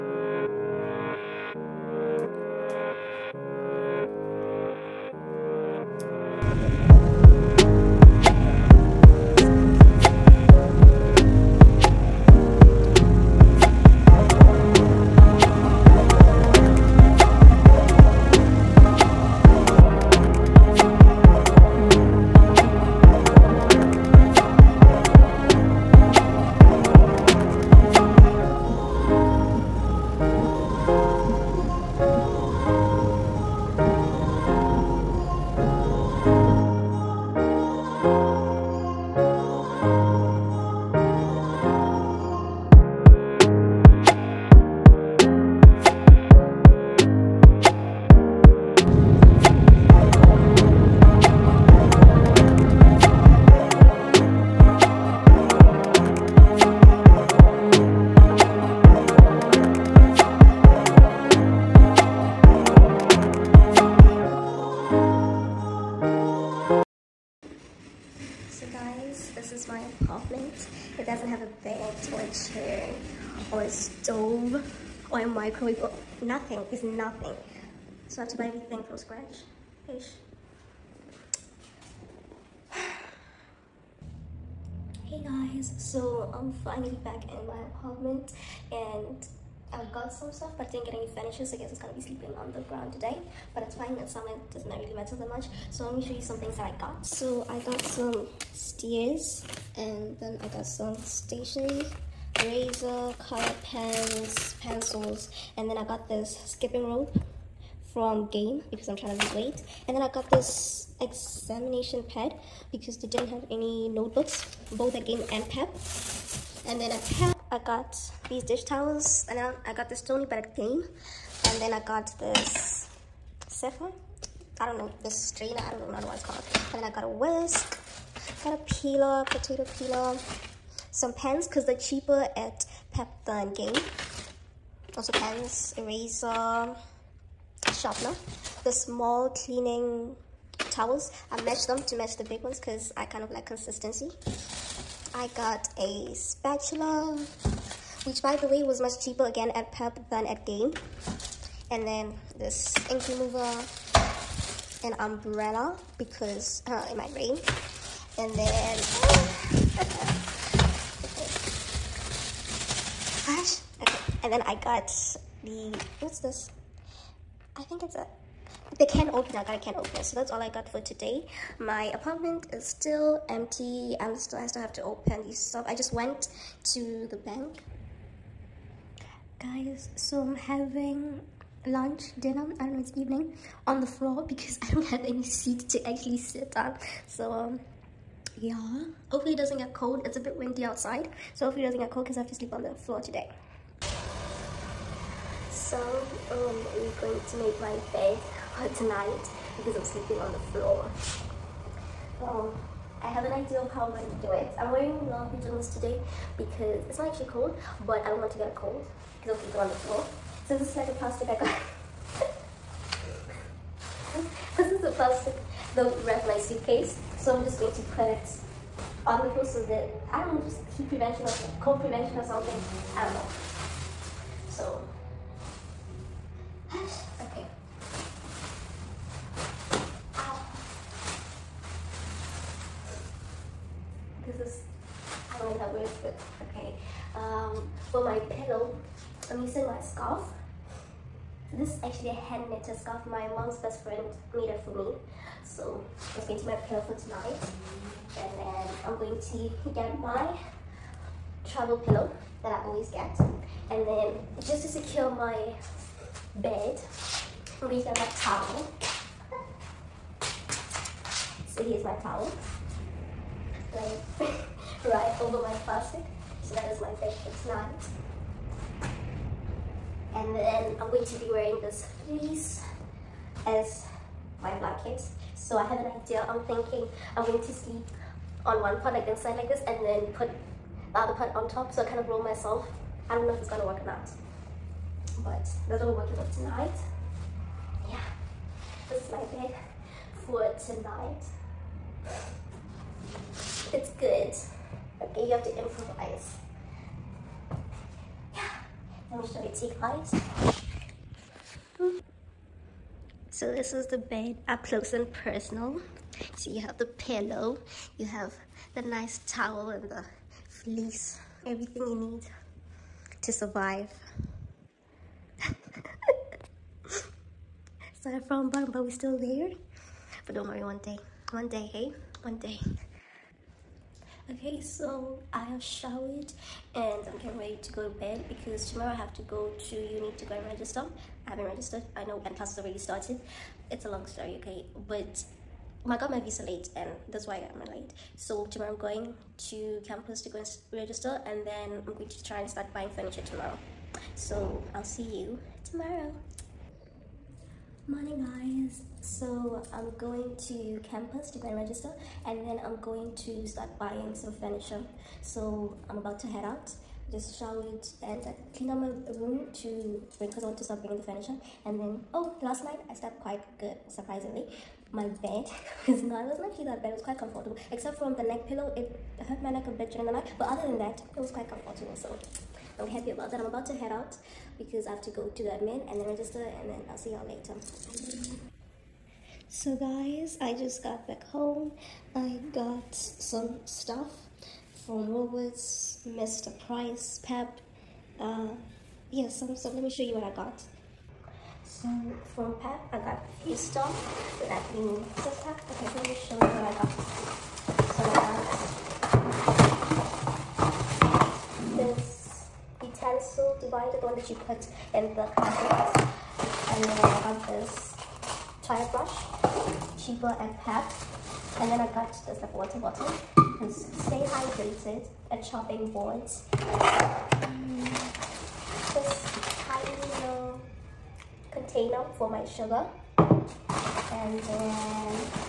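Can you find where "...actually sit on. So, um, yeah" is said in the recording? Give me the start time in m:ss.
3:05.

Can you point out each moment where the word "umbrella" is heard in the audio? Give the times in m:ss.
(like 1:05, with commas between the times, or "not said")
2:34.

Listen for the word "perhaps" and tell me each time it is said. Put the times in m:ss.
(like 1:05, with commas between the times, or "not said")
not said.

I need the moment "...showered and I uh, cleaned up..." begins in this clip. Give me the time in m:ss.
5:57.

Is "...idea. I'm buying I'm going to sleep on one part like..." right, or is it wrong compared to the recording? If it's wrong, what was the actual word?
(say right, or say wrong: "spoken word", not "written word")
wrong: "thinking", not "buying".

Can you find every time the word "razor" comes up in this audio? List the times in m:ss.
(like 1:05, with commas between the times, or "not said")
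1:42.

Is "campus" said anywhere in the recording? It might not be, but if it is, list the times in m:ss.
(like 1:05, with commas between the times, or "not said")
5:39, 5:50.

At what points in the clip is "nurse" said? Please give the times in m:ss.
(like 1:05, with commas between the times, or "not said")
not said.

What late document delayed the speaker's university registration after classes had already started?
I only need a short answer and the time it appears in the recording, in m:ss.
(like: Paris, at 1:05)
visa, at 5:36.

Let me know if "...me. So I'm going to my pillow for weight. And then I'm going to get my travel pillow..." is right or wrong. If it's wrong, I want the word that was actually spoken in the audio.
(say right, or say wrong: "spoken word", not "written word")
wrong: "tonight", not "weight".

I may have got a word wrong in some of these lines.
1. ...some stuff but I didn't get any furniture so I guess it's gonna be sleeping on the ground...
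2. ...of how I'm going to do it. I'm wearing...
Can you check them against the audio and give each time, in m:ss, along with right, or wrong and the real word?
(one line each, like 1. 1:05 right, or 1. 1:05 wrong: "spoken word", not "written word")
1. 1:30 right
2. 3:23 right.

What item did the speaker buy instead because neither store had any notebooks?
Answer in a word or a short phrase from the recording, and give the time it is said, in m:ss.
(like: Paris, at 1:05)
examination pad, at 1:51.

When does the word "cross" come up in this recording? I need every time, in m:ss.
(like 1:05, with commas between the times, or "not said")
not said.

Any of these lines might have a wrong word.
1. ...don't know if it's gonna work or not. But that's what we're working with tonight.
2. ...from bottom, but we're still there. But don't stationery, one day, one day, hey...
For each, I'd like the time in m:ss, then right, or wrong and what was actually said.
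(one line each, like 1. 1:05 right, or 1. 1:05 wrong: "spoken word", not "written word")
1. 4:43 right
2. 5:18 wrong: "worry", not "stationery".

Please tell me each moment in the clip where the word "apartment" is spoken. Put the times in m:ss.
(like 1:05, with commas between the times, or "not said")
1:27, 2:51.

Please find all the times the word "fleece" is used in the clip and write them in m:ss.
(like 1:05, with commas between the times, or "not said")
4:32, 5:10.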